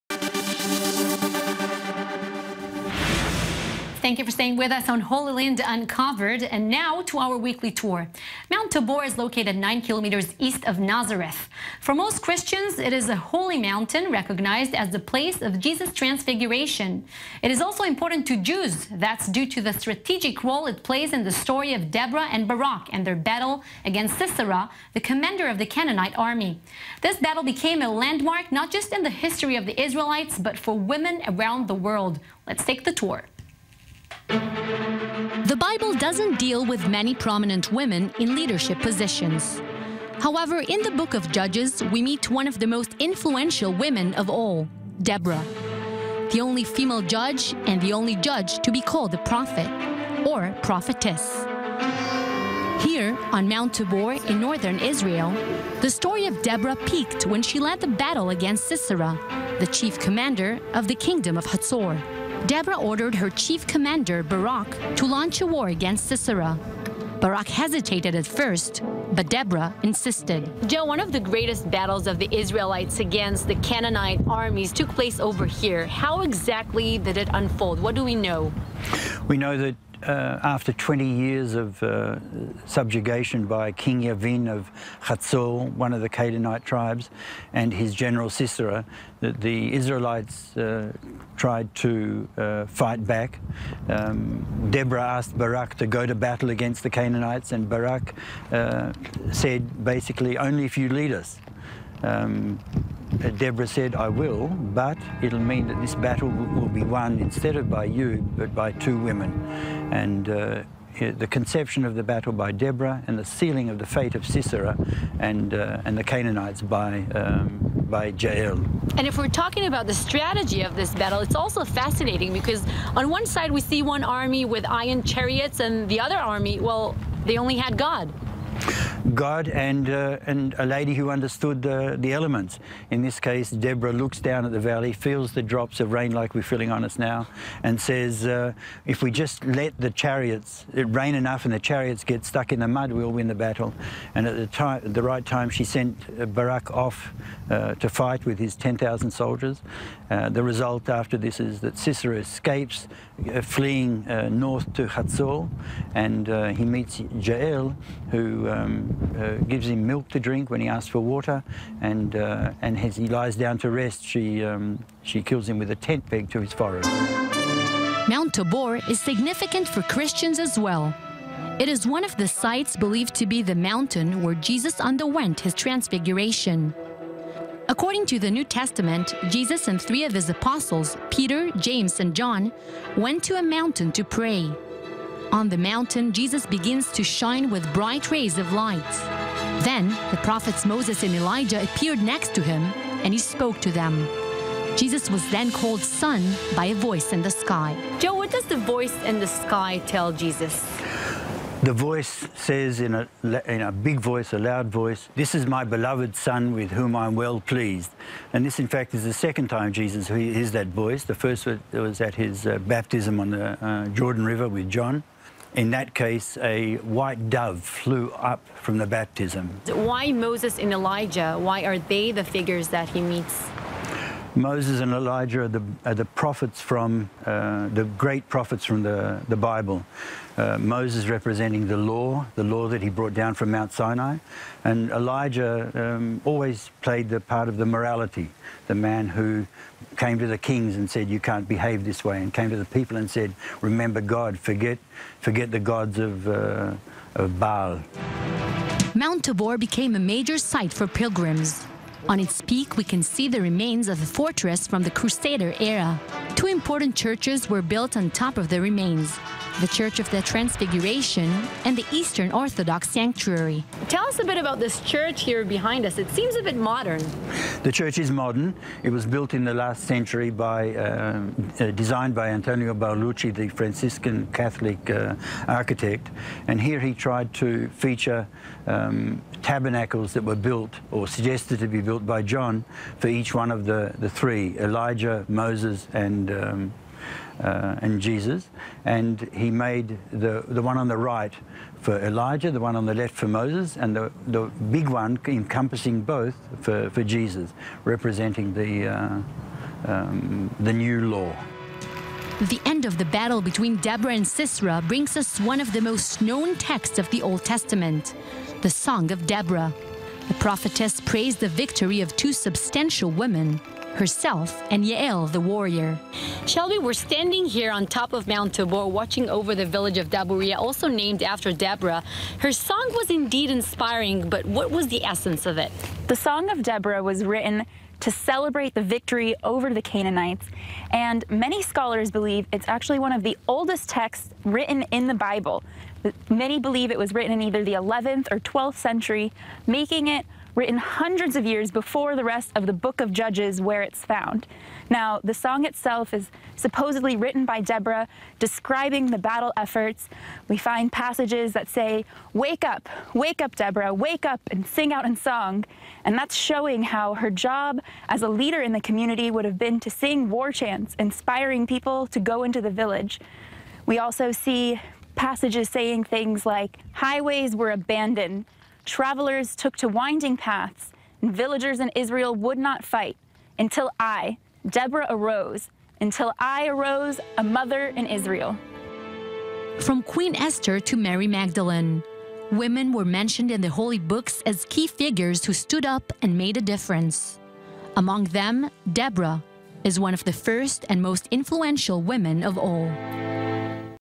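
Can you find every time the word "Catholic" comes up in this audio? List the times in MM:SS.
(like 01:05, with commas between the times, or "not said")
04:34.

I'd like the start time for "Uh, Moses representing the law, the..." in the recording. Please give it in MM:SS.
03:50.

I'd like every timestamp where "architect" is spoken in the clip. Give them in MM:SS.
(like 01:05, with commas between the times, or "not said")
04:35.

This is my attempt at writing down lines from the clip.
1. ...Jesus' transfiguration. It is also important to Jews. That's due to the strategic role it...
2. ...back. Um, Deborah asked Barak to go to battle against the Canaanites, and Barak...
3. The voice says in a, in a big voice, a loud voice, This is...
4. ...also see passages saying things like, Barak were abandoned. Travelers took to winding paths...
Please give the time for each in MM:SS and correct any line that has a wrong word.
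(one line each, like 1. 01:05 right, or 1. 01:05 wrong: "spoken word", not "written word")
1. 00:15 right
2. 01:33 right
3. 03:21 right
4. 06:03 wrong: "Highways", not "Barak".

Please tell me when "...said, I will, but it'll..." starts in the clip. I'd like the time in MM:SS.
01:43.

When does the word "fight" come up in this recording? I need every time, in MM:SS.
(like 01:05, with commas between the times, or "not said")
01:32, 02:27, 06:12.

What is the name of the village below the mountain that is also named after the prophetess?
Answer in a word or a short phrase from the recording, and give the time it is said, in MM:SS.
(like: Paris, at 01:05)
Daburia, at 05:20.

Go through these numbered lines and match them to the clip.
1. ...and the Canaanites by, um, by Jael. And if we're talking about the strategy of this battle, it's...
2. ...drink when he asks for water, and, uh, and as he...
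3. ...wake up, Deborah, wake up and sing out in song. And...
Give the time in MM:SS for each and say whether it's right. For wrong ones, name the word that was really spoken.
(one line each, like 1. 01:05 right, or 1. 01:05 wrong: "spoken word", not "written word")
1. 01:55 right
2. 02:40 right
3. 05:53 right.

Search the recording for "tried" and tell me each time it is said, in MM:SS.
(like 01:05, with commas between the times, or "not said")
01:31, 04:36.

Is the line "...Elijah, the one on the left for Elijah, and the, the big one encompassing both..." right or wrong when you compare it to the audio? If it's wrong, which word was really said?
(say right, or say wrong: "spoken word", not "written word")
wrong: "Moses", not "Elijah".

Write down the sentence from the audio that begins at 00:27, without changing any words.
This battle became a landmark not just in the history of the Israelites, but for women around the world.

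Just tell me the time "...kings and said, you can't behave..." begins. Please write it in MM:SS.
04:00.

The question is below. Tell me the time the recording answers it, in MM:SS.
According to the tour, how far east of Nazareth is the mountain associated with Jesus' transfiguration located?
00:09.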